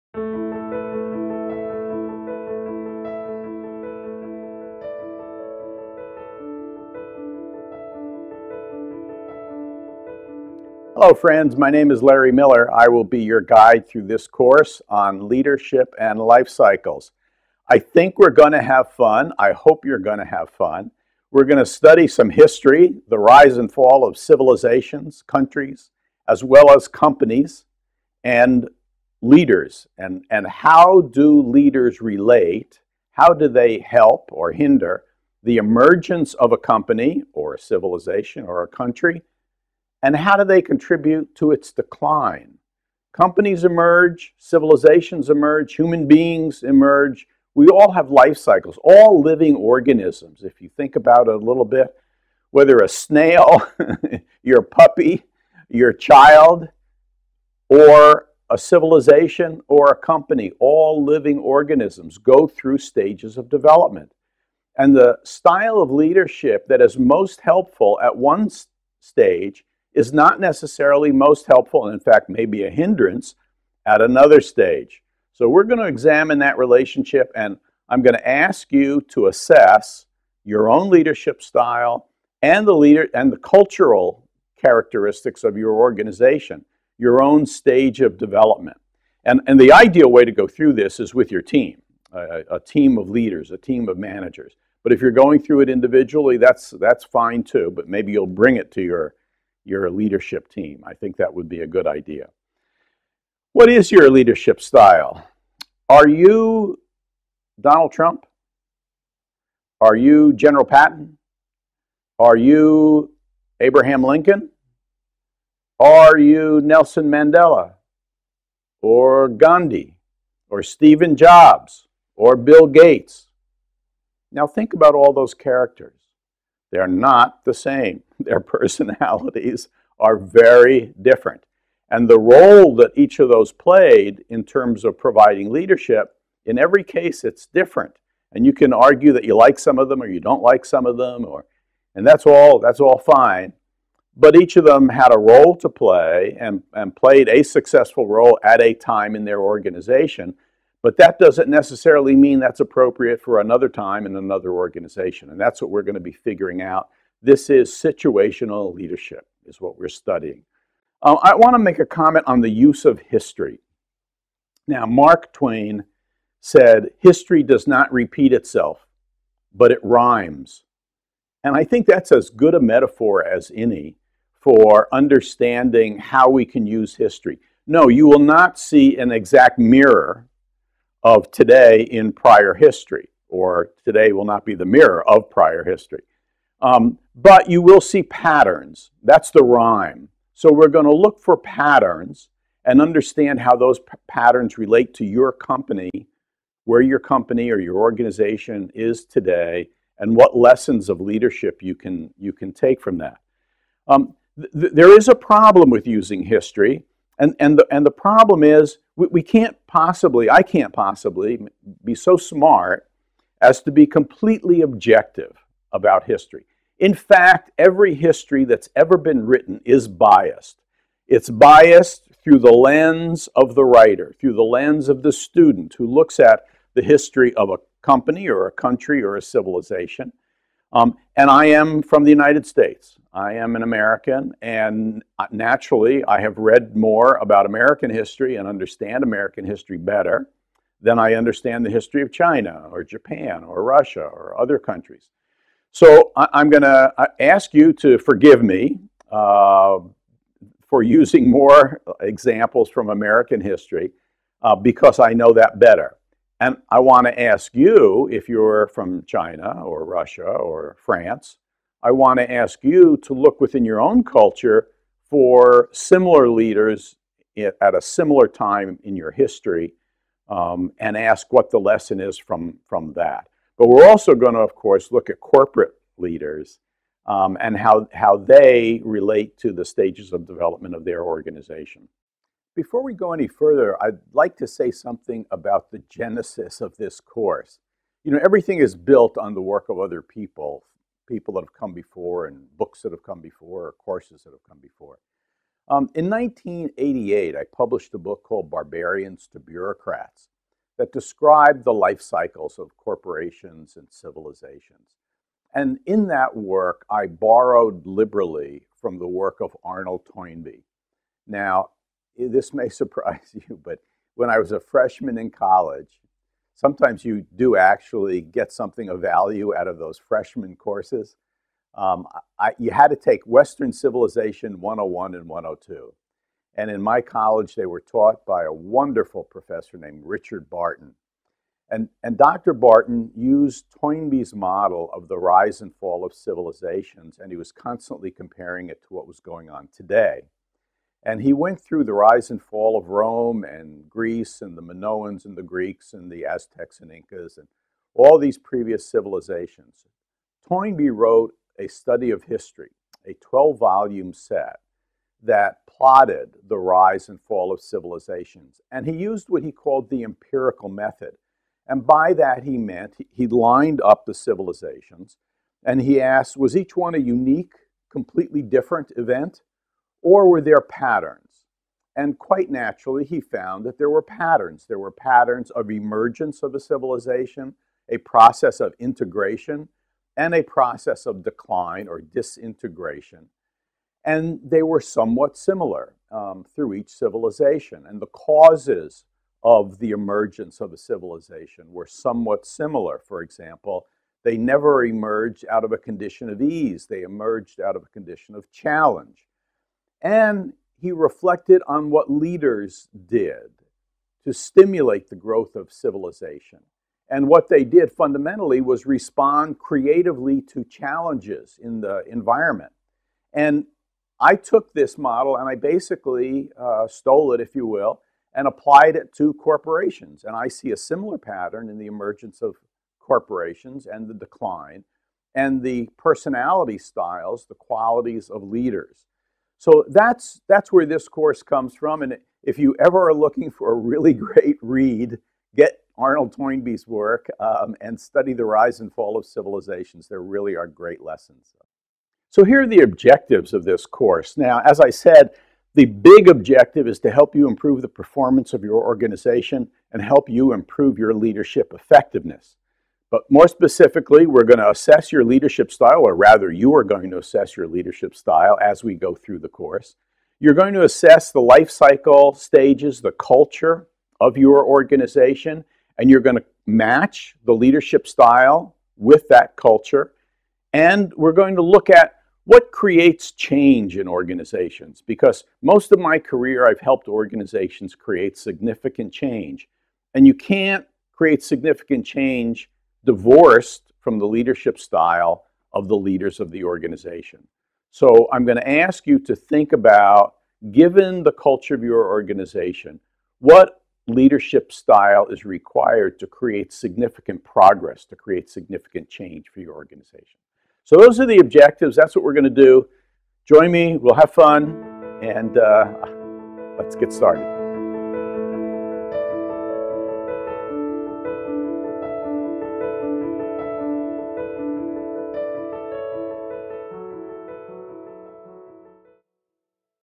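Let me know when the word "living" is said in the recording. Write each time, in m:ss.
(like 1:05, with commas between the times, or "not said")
0:49, 1:01.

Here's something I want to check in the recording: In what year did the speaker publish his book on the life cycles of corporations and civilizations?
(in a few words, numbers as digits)
1988.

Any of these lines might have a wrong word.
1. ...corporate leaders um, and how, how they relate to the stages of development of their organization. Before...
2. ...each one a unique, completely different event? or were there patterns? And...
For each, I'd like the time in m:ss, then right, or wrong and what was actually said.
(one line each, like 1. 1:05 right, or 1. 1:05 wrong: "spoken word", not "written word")
1. 4:35 right
2. 6:06 right.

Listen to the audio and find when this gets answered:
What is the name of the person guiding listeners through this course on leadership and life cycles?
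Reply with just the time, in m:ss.
0:12.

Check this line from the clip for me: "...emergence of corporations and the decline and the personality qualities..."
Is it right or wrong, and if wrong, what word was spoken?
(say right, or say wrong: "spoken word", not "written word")
wrong: "styles", not "qualities".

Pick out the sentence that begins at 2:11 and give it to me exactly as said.
And the role that each of those played in terms of providing leadership, in every case, it's different.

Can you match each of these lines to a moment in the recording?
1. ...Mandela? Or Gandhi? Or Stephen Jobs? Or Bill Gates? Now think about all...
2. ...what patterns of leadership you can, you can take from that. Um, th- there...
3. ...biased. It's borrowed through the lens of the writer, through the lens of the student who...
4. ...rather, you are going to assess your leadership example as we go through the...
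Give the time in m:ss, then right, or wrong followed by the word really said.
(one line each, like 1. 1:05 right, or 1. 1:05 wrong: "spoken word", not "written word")
1. 1:57 right
2. 3:20 wrong: "lessons", not "patterns"
3. 3:39 wrong: "biased", not "borrowed"
4. 7:36 wrong: "style", not "example".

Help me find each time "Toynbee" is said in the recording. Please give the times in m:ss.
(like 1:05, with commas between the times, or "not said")
5:10, 5:33, 5:50, 7:16.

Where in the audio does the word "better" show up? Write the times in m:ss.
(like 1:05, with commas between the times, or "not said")
3:59, 4:15.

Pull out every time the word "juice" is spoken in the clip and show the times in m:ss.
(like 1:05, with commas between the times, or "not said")
not said.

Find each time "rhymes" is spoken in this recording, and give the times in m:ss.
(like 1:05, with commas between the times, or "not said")
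2:49, 3:09.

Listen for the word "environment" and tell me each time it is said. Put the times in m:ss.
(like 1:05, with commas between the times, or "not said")
6:52.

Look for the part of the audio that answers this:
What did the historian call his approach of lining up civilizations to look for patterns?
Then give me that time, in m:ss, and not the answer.
6:00.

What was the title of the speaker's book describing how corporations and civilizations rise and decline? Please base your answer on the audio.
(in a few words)
Barbarians to Bureaucrats.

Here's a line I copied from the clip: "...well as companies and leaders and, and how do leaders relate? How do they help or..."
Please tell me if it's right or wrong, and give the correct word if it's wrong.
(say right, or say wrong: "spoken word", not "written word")
right.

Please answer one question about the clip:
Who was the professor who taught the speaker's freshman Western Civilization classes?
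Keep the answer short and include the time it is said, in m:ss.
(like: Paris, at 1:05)
Richard Barton, at 5:30.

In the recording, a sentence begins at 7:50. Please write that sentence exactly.
And we're going to look at what creates change in organizations?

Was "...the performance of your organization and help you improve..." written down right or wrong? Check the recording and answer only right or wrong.
right.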